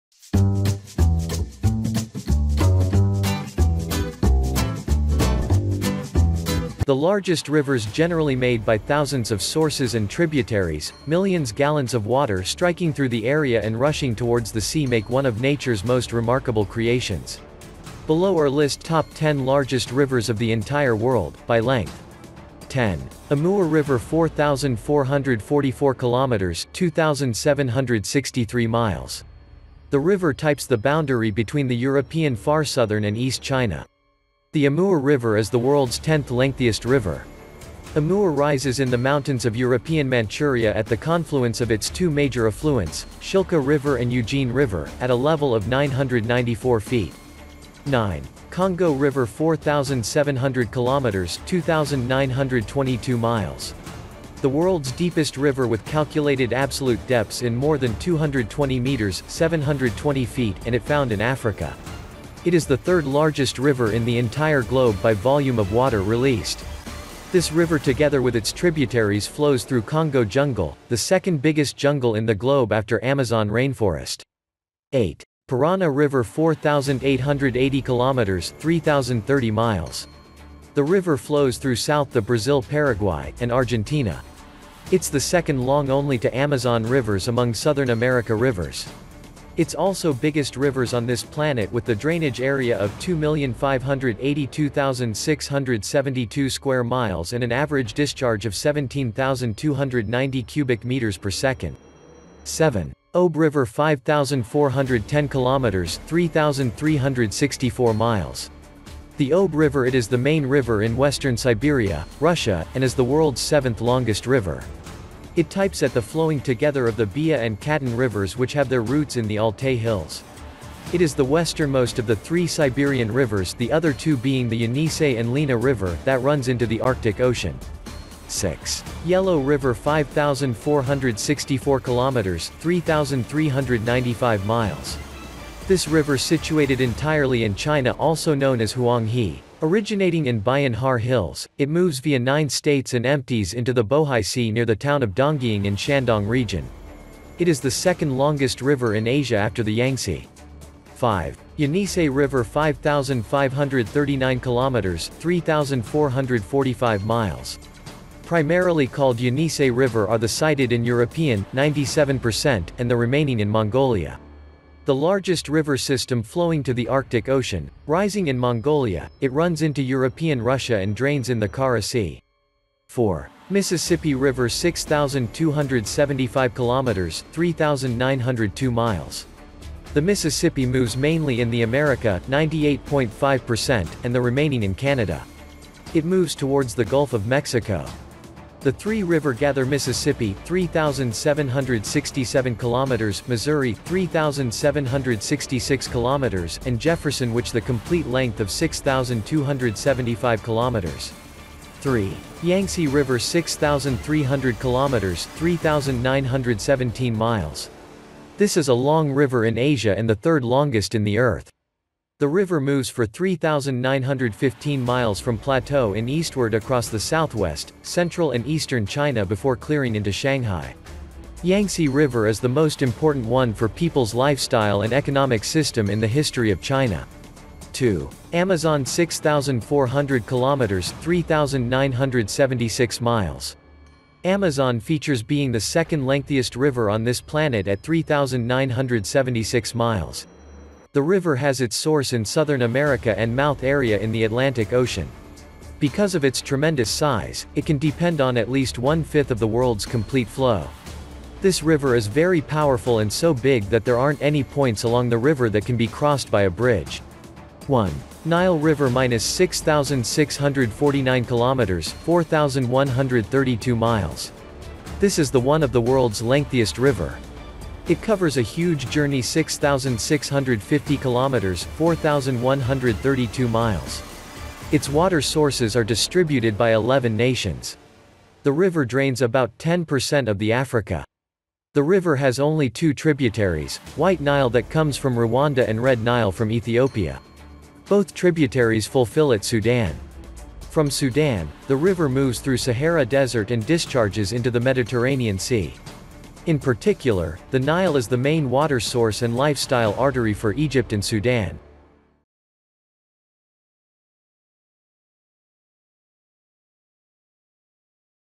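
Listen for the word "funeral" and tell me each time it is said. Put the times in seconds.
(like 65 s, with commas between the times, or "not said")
not said.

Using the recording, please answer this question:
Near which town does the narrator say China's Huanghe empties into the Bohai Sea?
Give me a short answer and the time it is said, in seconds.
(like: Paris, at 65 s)
Dongying, at 145 s.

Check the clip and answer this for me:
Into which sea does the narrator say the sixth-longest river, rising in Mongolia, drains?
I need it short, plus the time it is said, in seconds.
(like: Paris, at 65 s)
Kara Sea, at 171 s.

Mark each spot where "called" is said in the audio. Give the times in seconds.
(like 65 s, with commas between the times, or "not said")
158 s.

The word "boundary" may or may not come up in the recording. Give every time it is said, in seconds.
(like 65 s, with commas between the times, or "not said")
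30 s.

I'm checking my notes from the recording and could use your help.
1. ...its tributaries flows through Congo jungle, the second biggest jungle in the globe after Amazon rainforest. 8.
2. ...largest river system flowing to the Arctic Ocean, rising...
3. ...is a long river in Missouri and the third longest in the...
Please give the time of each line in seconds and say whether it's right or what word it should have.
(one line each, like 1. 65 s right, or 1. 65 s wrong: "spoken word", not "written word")
1. 68 s right
2. 164 s right
3. 208 s wrong: "Asia", not "Missouri".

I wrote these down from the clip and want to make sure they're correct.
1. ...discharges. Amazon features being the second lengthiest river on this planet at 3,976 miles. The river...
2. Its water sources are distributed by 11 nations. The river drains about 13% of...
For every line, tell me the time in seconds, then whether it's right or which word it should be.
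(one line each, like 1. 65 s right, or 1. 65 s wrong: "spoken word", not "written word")
1. 233 s wrong: "miles", not "discharges"
2. 274 s wrong: "10", not "13".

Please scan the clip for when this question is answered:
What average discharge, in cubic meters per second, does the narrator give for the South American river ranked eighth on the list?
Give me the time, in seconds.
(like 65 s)
98 s.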